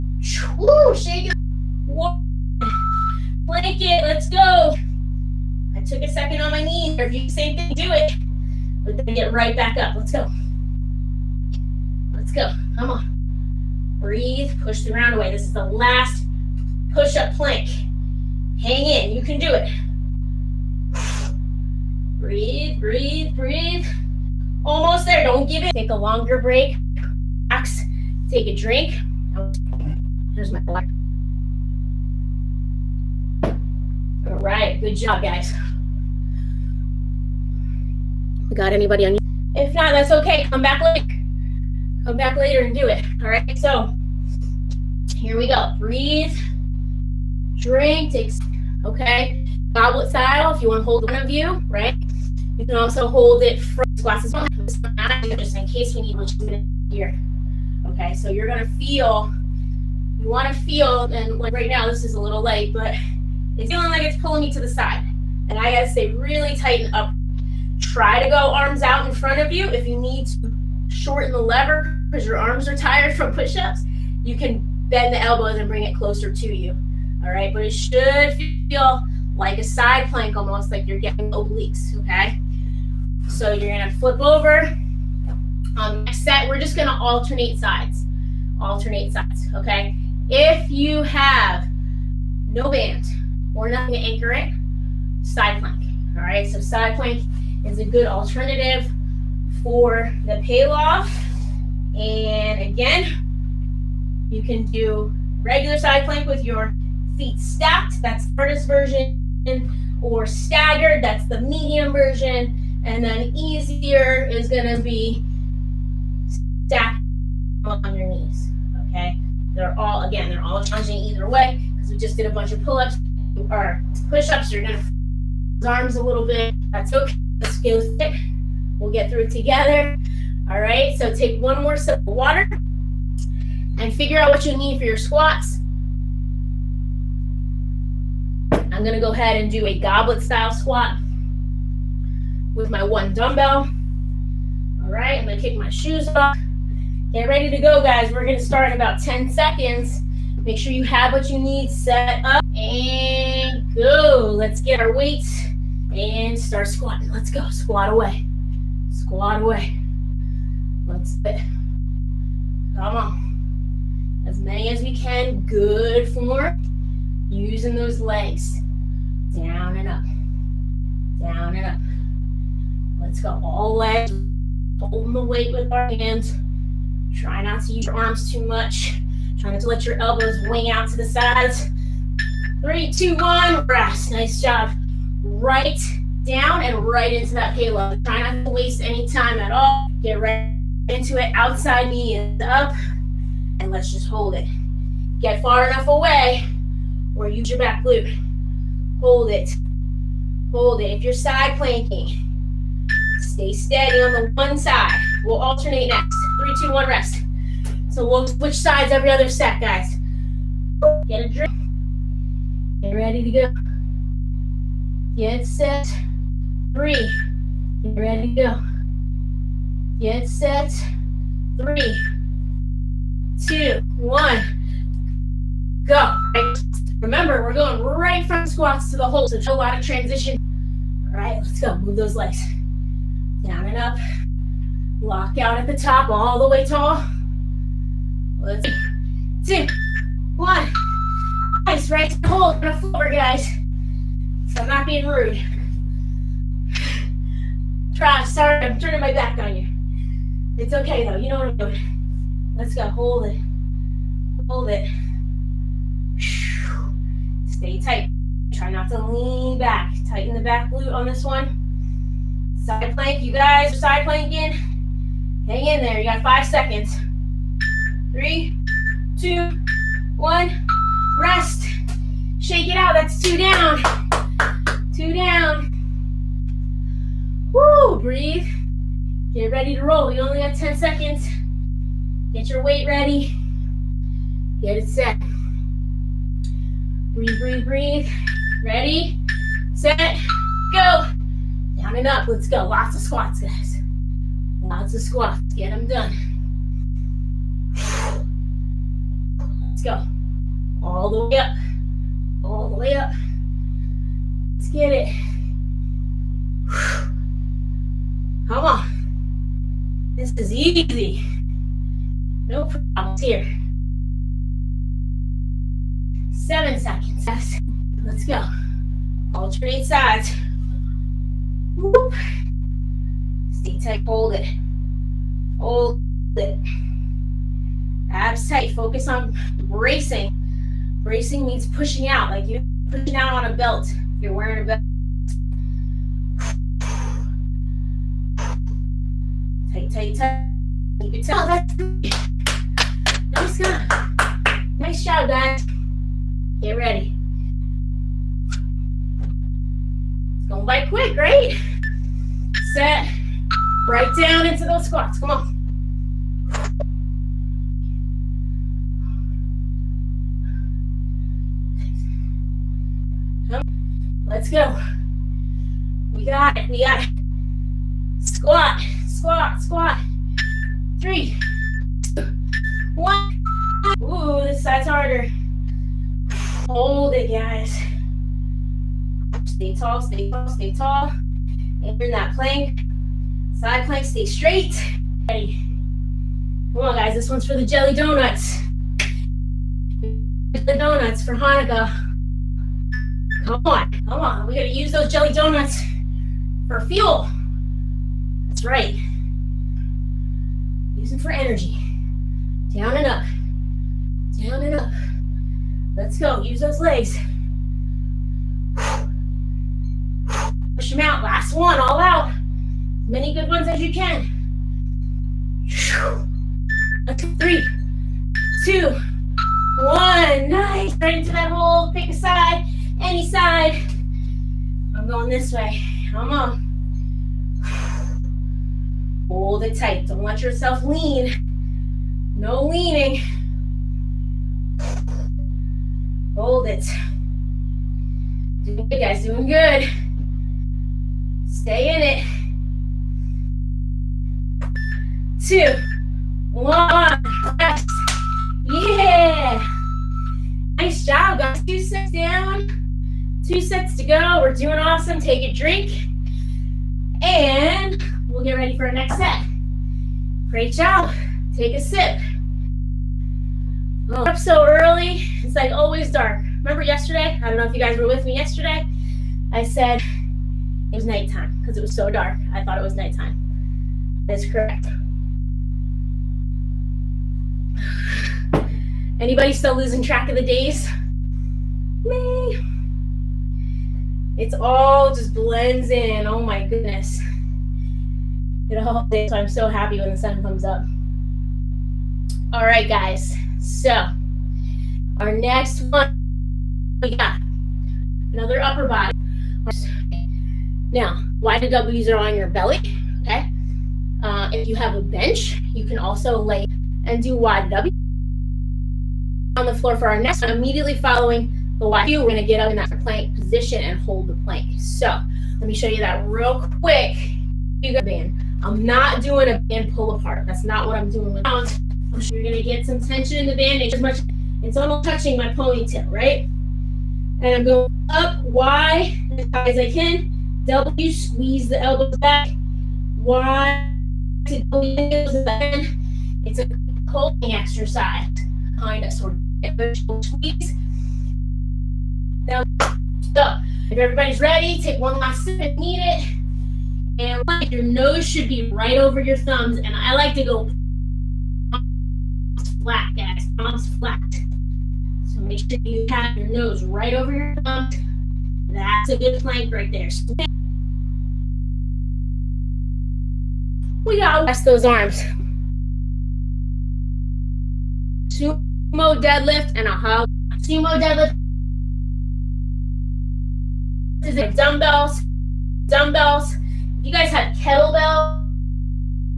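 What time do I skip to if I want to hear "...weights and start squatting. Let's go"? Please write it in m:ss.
2:34.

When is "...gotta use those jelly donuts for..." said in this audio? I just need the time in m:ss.
6:34.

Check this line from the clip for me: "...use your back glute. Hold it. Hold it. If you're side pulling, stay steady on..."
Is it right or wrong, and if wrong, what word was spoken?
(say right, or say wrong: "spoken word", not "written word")
wrong: "planking", not "pulling".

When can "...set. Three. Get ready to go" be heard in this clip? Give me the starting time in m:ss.
3:35.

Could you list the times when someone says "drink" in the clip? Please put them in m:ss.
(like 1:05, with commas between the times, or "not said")
0:28, 0:47, 3:31, 7:35.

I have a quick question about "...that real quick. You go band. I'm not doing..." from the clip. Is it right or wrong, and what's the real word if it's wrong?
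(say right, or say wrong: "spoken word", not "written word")
right.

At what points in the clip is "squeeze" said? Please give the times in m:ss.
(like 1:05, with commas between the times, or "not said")
8:51, 9:00.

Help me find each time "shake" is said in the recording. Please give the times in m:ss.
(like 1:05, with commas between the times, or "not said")
0:00, 4:32.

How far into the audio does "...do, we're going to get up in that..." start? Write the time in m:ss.
8:32.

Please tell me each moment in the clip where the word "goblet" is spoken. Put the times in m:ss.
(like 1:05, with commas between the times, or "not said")
0:49, 2:19.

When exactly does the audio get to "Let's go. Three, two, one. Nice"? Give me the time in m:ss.
6:57.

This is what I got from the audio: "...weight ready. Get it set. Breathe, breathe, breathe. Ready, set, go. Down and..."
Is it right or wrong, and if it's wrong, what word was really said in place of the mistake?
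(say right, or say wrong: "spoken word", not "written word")
right.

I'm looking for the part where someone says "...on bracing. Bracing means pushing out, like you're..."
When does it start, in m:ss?
5:29.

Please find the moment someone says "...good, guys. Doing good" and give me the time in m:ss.
7:18.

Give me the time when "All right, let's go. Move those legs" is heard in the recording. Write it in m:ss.
3:51.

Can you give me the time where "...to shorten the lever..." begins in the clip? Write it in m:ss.
1:10.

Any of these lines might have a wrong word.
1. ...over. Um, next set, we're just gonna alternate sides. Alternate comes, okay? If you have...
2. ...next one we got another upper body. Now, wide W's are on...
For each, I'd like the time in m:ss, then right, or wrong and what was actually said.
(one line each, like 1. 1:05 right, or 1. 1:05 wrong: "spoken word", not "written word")
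1. 1:24 wrong: "sides", not "comes"
2. 8:15 right.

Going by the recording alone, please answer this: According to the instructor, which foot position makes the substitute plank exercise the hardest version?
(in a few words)
Feet stacked.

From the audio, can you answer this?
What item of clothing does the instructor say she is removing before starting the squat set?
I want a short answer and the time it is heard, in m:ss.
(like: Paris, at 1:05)
Shoes, at 2:25.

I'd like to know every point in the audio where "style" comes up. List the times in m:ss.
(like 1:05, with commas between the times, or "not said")
0:50, 2:20.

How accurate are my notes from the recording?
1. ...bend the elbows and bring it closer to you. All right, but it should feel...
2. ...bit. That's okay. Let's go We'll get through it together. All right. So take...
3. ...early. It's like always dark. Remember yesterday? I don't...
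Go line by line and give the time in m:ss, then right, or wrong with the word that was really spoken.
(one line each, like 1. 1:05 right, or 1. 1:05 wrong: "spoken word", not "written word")
1. 1:14 right
2. 2:06 right
3. 7:44 right.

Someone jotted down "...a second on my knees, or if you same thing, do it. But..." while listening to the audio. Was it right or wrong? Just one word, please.
right.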